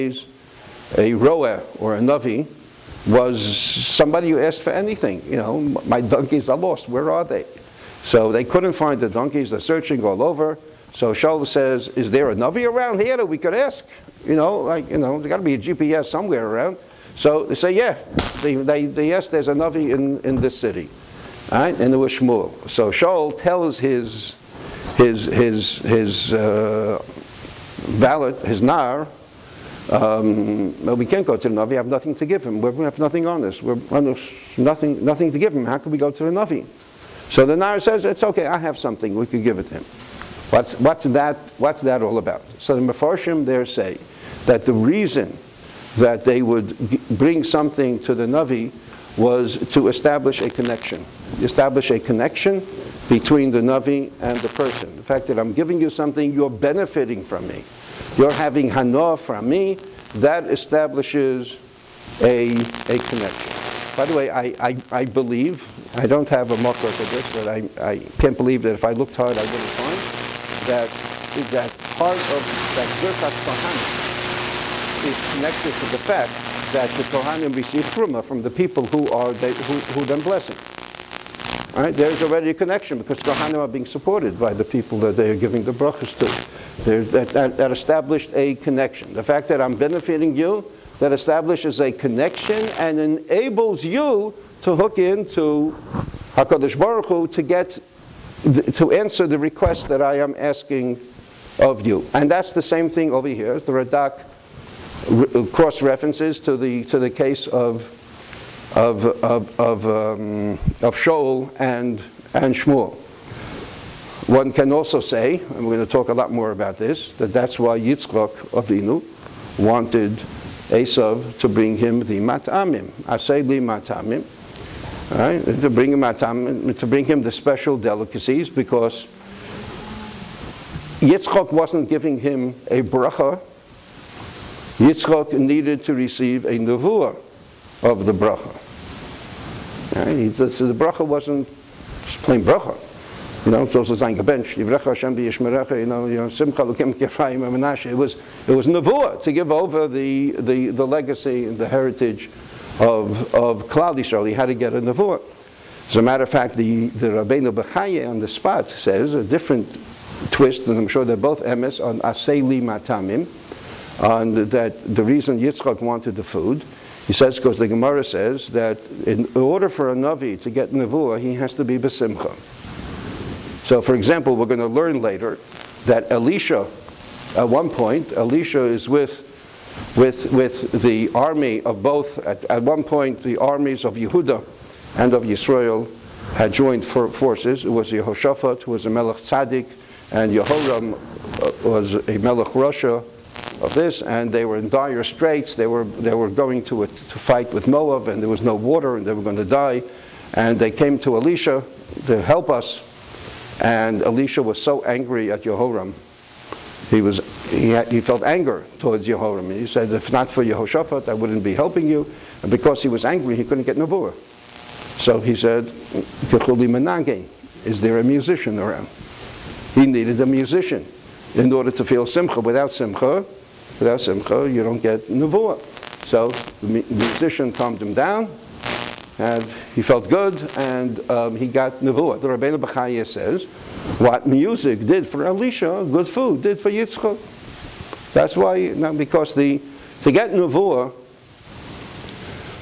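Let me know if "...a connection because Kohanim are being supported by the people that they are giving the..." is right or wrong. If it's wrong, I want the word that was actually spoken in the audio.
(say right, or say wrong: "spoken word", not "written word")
right.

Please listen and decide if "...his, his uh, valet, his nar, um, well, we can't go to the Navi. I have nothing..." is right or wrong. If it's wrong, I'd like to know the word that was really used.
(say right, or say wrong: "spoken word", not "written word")
right.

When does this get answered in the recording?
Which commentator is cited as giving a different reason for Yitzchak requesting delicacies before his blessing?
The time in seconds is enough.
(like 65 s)
157 s.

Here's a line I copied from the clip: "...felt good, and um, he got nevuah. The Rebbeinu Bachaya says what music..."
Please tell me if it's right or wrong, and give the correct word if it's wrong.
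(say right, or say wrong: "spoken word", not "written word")
right.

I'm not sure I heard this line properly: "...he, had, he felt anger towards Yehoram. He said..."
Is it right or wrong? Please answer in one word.
right.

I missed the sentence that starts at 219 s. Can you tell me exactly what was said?
He needed a musician in order to feel simcha.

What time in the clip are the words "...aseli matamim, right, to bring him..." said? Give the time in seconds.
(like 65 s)
123 s.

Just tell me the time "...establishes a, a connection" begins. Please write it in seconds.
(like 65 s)
60 s.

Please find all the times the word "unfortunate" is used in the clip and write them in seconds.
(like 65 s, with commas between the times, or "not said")
not said.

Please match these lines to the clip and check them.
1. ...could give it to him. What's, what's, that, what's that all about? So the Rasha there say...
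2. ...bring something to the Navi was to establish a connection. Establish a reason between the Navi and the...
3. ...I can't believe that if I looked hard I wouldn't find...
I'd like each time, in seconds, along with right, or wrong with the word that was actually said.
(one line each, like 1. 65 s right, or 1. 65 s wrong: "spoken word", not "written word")
1. 39 s wrong: "Mefarshim", not "Rasha"
2. 47 s wrong: "connection", not "reason"
3. 67 s right.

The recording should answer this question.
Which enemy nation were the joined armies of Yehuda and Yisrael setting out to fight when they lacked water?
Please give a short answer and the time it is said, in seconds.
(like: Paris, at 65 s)
Moab, at 197 s.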